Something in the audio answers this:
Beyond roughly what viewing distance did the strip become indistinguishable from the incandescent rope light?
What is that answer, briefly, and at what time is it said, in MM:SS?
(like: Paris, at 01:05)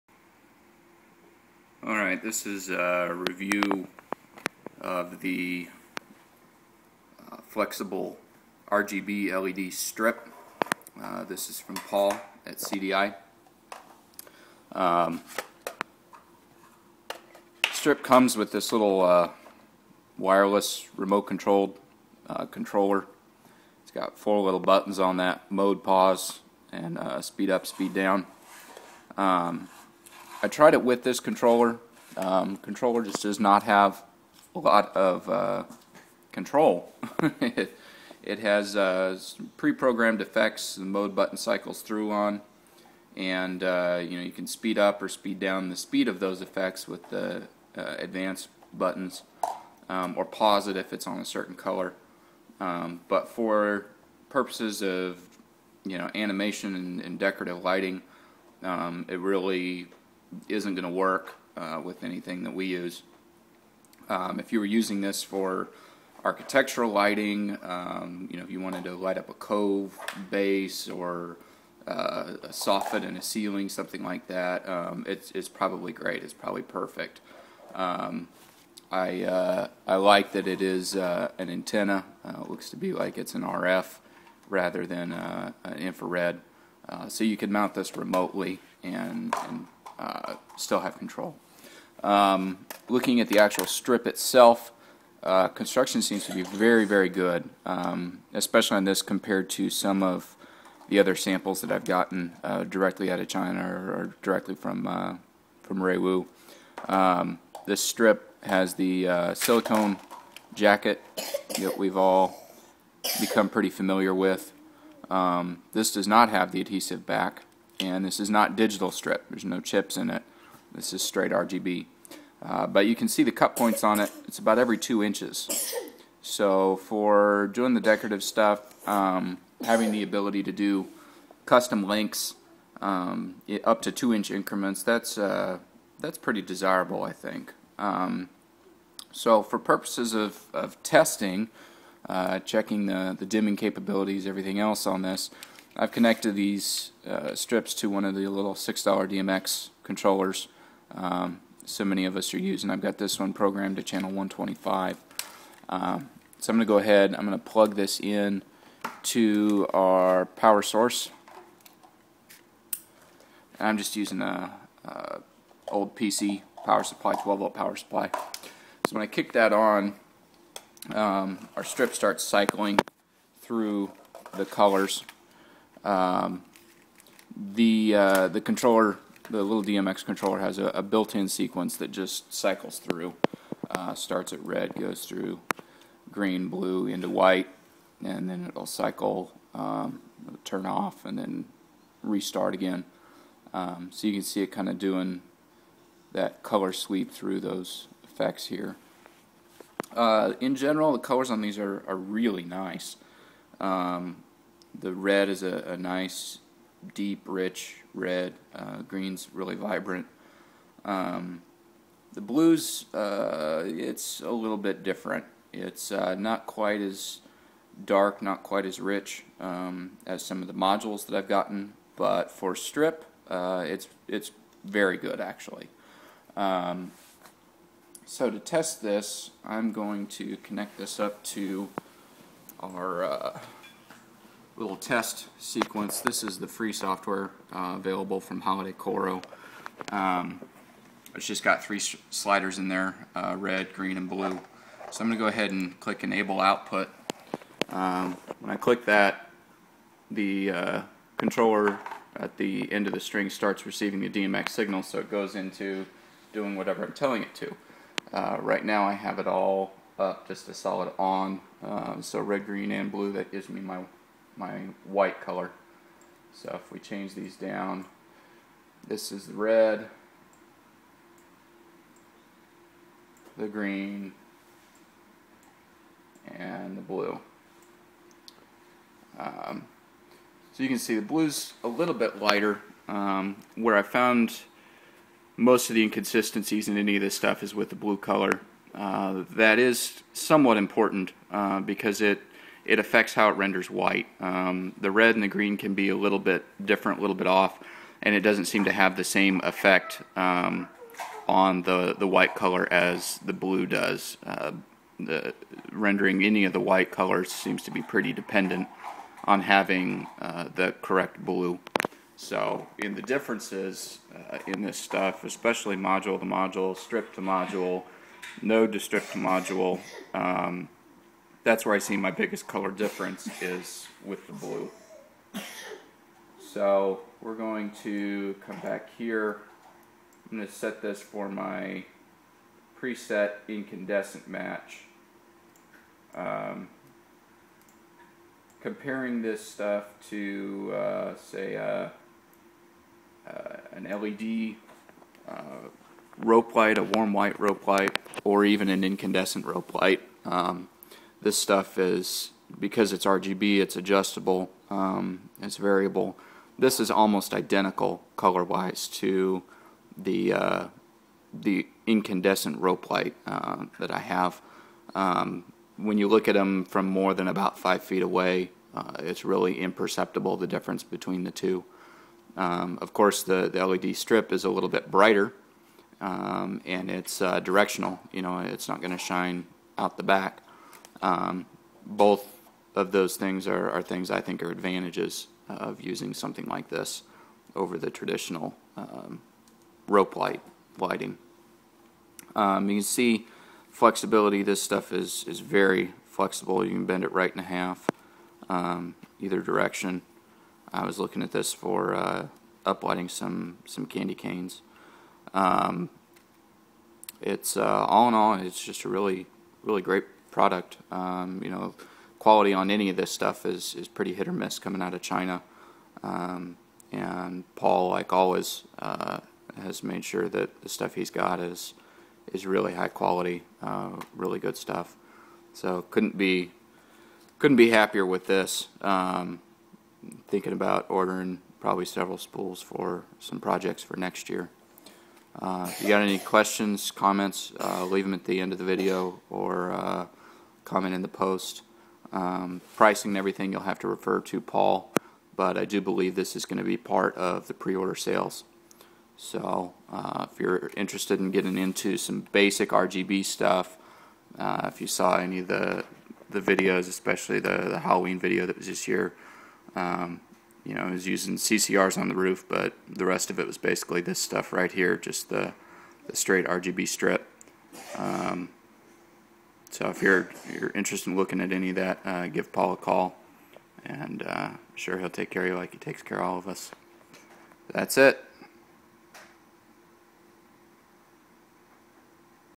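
5 feet, at 06:07.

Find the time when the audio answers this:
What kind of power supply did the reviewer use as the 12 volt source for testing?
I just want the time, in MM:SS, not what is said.
02:45.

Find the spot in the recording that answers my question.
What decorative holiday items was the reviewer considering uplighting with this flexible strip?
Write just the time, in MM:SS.
06:43.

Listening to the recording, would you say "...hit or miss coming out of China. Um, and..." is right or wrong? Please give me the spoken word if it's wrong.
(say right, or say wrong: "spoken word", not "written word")
right.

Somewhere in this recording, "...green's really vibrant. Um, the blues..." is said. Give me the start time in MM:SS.
03:28.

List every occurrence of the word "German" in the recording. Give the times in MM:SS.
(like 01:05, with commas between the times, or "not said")
not said.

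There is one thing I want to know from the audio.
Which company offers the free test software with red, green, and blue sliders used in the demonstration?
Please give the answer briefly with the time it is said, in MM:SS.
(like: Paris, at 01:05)
HolidayCoro, at 03:58.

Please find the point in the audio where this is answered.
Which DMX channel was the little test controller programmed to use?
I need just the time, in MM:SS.
02:34.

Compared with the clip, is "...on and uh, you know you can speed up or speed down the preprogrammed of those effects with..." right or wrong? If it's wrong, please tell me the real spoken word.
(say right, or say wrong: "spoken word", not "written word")
wrong: "speed", not "preprogrammed".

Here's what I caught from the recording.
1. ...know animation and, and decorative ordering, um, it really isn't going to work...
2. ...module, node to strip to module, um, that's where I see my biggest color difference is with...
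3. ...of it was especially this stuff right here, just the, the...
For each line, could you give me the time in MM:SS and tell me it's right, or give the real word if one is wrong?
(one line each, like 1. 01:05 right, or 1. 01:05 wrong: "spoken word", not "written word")
1. 00:55 wrong: "lighting", not "ordering"
2. 05:17 right
3. 07:43 wrong: "basically", not "especially".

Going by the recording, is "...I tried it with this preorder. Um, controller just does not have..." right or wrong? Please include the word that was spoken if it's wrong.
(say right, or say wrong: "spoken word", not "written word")
wrong: "controller", not "preorder".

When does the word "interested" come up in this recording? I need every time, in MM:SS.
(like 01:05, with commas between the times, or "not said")
07:30, 07:50.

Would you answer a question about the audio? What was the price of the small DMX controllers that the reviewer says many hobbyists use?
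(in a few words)
$6.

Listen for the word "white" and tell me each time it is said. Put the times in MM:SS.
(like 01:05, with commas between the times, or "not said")
03:07, 04:24, 04:53, 05:02, 05:06, 05:47.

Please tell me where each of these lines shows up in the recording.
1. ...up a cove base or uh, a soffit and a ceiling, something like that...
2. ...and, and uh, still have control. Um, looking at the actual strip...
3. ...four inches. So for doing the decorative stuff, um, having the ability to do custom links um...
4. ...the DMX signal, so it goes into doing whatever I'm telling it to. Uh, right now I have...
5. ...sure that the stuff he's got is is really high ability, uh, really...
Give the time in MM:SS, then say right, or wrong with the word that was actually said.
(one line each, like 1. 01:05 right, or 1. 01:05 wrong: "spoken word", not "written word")
1. 01:09 right
2. 01:28 right
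3. 02:04 wrong: "two", not "four"
4. 04:14 right
5. 07:00 wrong: "quality", not "ability".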